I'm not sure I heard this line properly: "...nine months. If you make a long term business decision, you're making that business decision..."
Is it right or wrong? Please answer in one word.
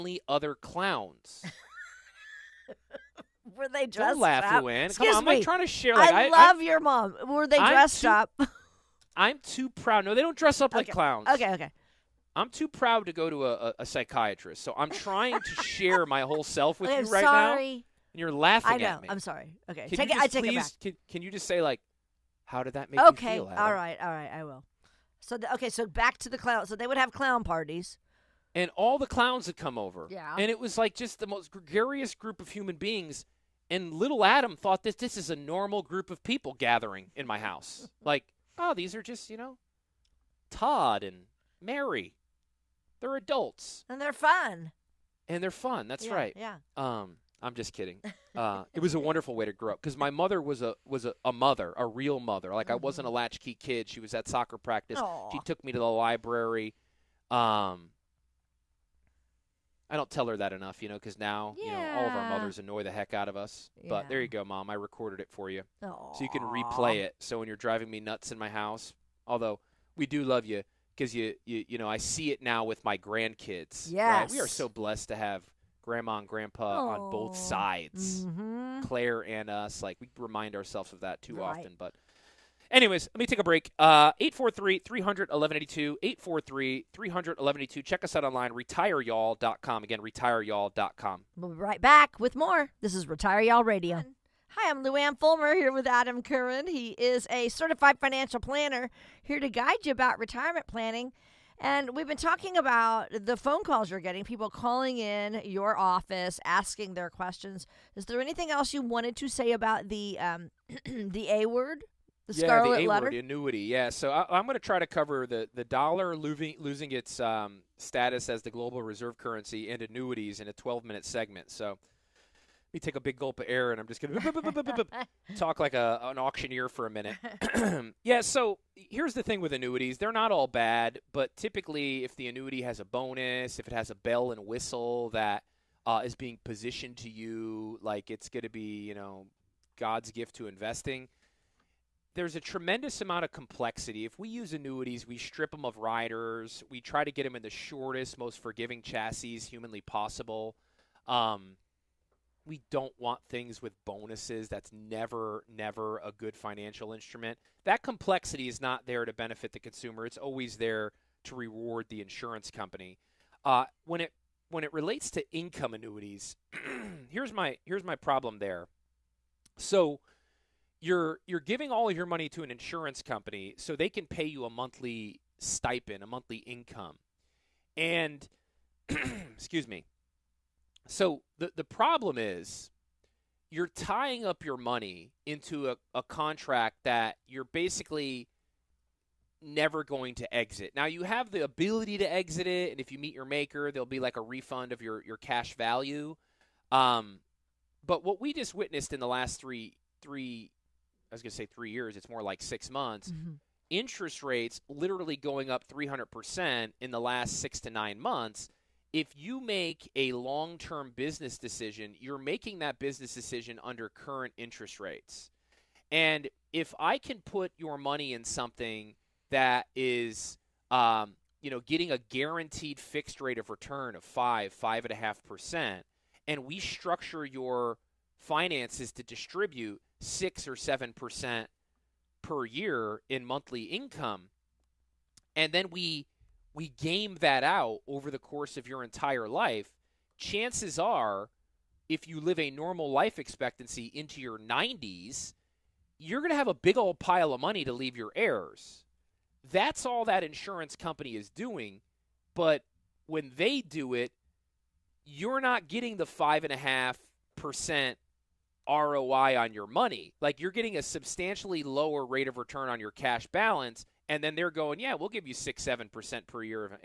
right.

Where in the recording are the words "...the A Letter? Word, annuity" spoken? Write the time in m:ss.
1:52.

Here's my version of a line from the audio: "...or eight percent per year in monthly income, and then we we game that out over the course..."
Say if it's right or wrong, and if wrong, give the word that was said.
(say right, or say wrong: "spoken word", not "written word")
wrong: "seven", not "eight".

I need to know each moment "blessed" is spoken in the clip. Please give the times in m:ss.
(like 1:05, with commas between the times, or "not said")
1:14.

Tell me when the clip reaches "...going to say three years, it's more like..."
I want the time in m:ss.
3:21.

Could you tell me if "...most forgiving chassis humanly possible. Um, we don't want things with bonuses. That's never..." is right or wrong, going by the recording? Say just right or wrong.
right.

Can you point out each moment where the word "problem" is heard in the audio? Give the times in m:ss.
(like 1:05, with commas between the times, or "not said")
2:47, 3:01.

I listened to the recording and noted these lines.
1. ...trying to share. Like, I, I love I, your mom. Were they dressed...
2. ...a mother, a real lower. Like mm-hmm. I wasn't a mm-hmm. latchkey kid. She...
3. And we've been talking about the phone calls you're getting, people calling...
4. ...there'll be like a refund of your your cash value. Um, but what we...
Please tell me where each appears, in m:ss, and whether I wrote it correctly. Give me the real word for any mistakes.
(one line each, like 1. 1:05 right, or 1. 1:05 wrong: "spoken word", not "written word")
1. 0:05 right
2. 0:51 wrong: "mother", not "lower"
3. 1:41 right
4. 3:13 right.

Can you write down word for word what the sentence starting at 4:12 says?
But when they do it, you're not getting the five and a half percent ROI on your money.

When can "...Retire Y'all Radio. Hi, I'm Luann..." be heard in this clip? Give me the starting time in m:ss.
1:33.